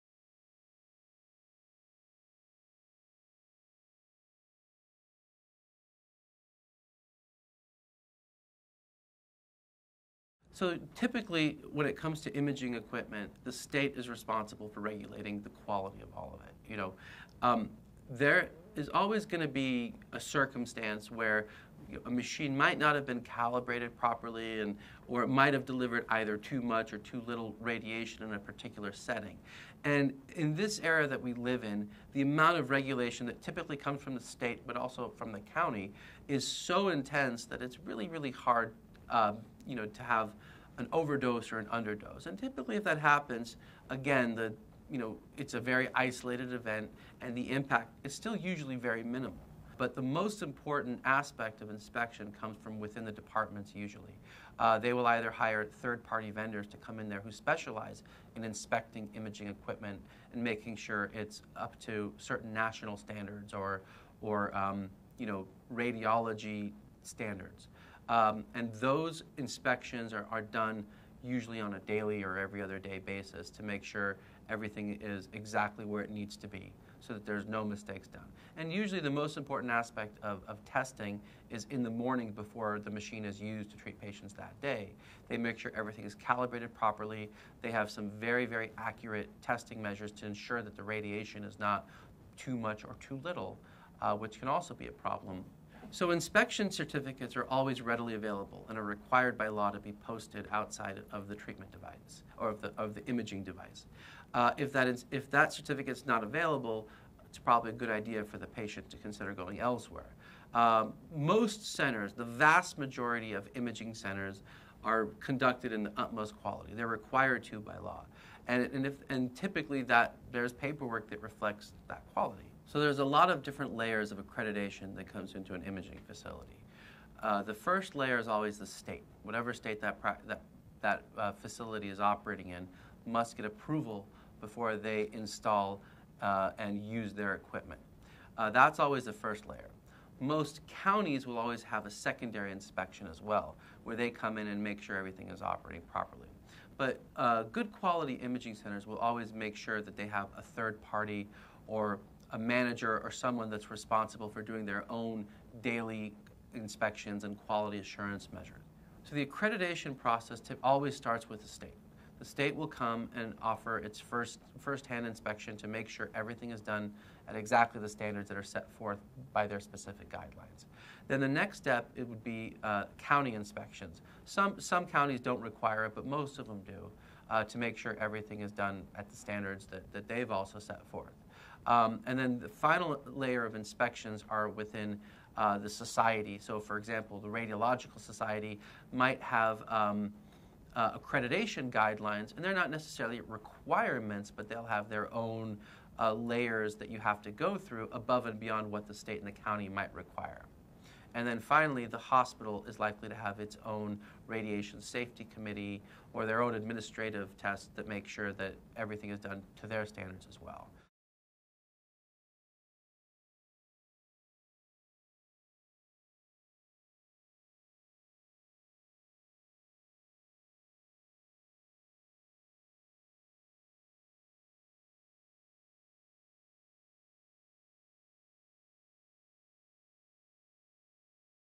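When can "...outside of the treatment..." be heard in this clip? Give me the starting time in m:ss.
1:40.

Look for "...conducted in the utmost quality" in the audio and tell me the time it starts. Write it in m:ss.
1:55.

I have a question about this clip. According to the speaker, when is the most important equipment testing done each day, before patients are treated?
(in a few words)
In the morning.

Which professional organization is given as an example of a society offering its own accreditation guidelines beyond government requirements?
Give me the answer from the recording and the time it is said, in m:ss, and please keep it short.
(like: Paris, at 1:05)
Radiological Society, at 3:07.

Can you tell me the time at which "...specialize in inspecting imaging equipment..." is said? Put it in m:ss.
0:57.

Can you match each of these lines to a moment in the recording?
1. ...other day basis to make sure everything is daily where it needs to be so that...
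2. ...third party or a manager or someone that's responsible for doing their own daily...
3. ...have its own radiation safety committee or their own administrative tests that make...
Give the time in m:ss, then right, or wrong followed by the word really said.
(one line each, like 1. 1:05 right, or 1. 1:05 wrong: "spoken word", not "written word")
1. 1:12 wrong: "exactly", not "daily"
2. 2:30 right
3. 3:23 right.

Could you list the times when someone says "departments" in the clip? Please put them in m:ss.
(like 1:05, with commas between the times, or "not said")
0:53.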